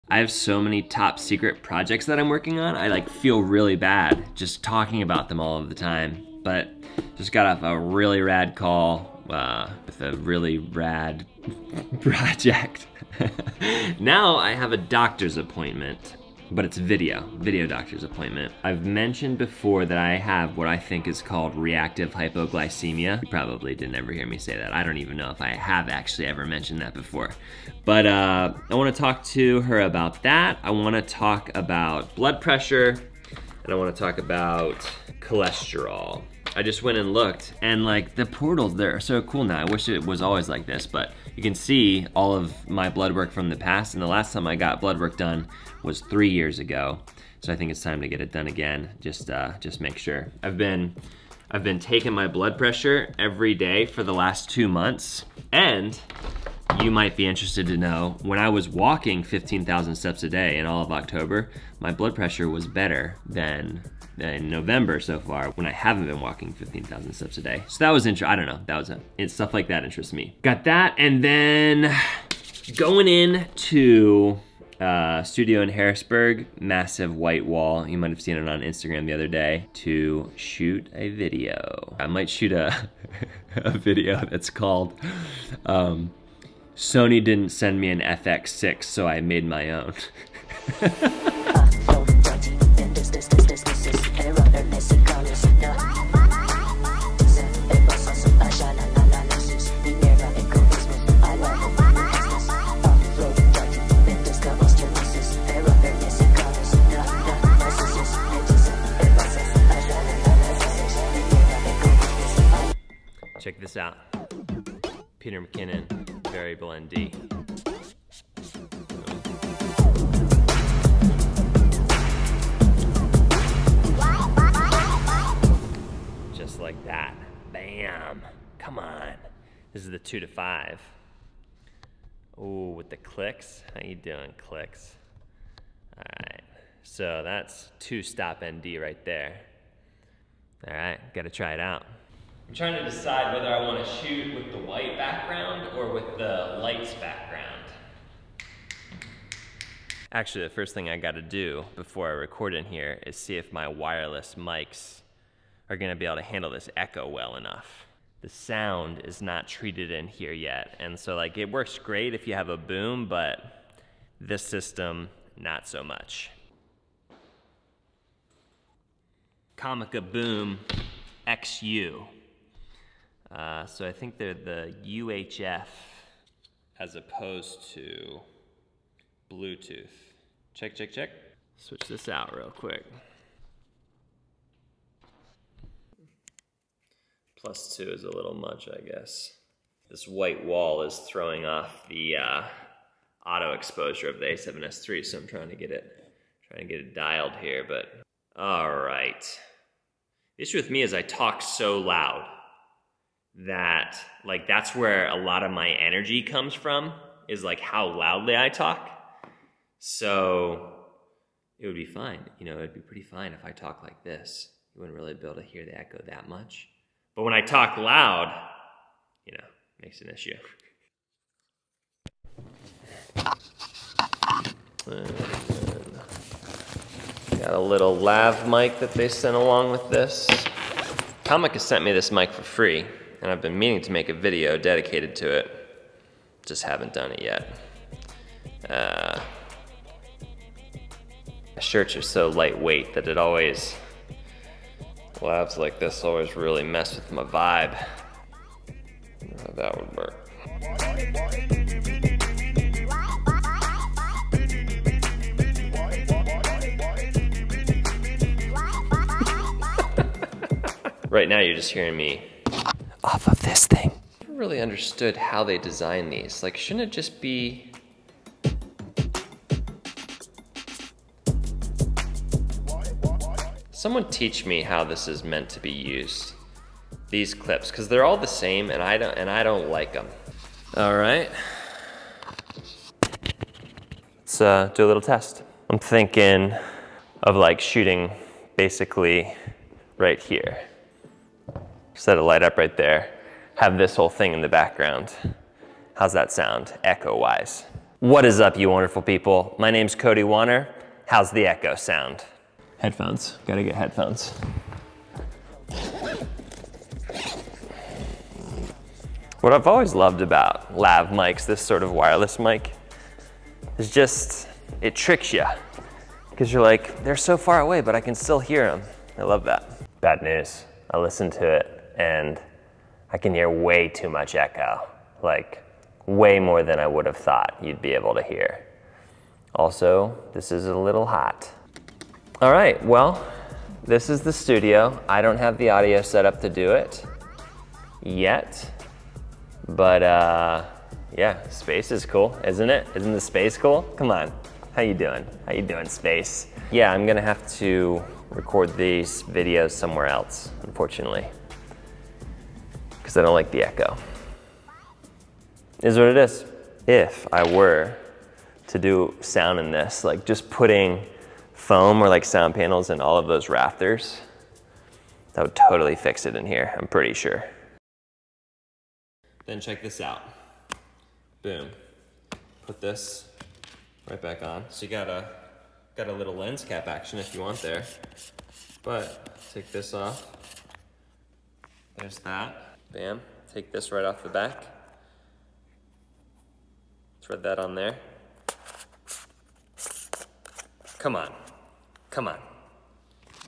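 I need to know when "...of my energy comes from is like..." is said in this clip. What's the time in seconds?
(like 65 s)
205 s.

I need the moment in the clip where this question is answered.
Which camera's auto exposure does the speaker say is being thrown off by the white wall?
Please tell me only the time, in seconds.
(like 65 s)
194 s.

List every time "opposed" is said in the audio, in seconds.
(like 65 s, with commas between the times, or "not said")
176 s.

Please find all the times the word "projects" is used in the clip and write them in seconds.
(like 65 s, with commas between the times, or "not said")
1 s, 12 s.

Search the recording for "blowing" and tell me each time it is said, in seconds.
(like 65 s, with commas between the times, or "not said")
not said.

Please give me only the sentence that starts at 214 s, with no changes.
You wouldn't really be able to hear the echo that much.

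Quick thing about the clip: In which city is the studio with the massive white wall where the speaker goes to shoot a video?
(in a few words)
Harrisburg.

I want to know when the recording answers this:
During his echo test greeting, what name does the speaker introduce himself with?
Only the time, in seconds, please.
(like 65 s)
299 s.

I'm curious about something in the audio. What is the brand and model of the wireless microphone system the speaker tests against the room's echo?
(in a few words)
Comica Boom XU.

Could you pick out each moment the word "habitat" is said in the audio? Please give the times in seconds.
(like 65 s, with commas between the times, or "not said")
not said.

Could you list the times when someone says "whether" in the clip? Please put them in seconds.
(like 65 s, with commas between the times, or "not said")
143 s.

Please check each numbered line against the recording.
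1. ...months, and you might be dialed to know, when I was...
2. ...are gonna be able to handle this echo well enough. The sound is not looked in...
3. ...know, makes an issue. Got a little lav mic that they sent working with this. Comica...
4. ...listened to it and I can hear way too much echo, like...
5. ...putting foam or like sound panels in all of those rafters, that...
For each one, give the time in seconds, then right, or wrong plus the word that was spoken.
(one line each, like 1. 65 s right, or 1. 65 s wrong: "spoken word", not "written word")
1. 54 s wrong: "interested", not "dialed"
2. 155 s wrong: "treated", not "looked"
3. 219 s wrong: "along", not "working"
4. 320 s right
5. 360 s right.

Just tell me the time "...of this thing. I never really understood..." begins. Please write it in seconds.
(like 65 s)
263 s.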